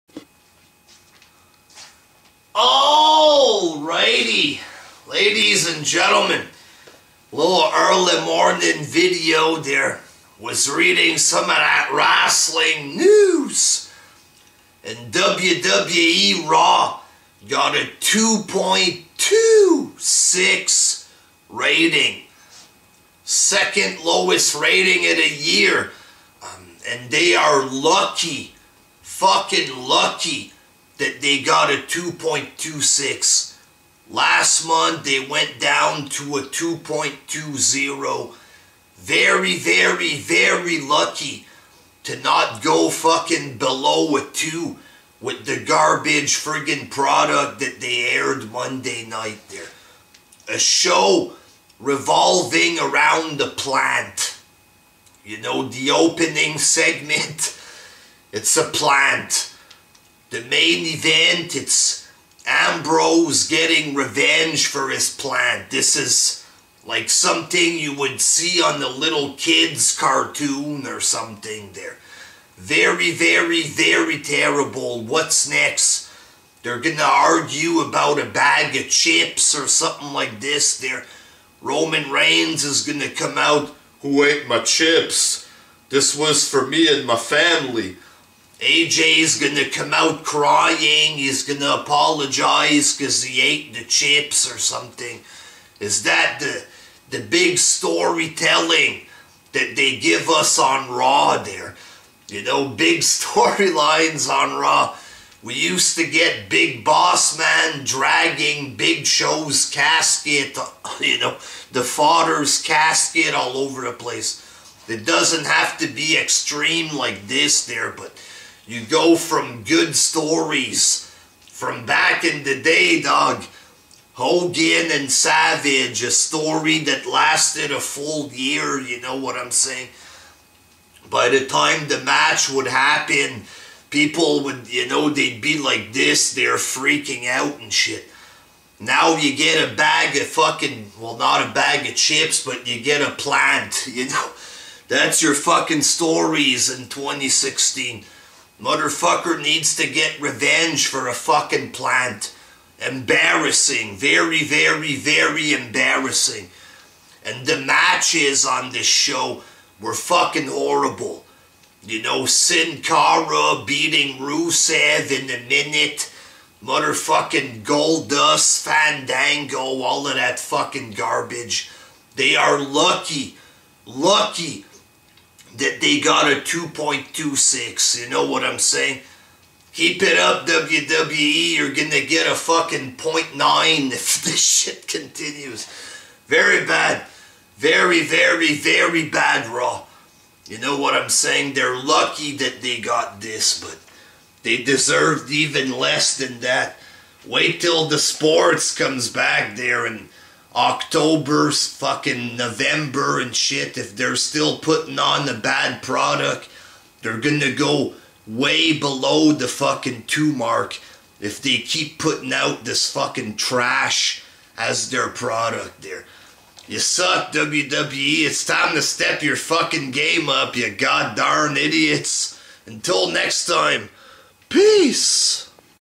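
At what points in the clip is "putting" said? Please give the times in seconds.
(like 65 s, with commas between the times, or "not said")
204 s, 211 s.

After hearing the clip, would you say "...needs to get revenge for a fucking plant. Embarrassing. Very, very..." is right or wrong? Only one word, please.
right.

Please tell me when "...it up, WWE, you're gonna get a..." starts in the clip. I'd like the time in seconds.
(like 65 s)
180 s.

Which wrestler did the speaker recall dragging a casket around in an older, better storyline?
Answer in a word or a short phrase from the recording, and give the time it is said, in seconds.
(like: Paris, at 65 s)
Big Boss Man, at 106 s.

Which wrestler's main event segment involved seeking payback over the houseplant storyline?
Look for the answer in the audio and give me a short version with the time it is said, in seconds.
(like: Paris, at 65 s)
Ambrose, at 62 s.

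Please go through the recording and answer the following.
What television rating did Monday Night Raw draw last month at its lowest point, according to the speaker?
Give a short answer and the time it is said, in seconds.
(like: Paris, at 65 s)
2.20, at 36 s.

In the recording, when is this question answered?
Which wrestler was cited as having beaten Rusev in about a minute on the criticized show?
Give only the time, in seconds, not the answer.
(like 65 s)
162 s.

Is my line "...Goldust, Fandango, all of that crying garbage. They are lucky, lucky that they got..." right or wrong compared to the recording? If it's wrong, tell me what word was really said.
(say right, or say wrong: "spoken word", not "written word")
wrong: "fucking", not "crying".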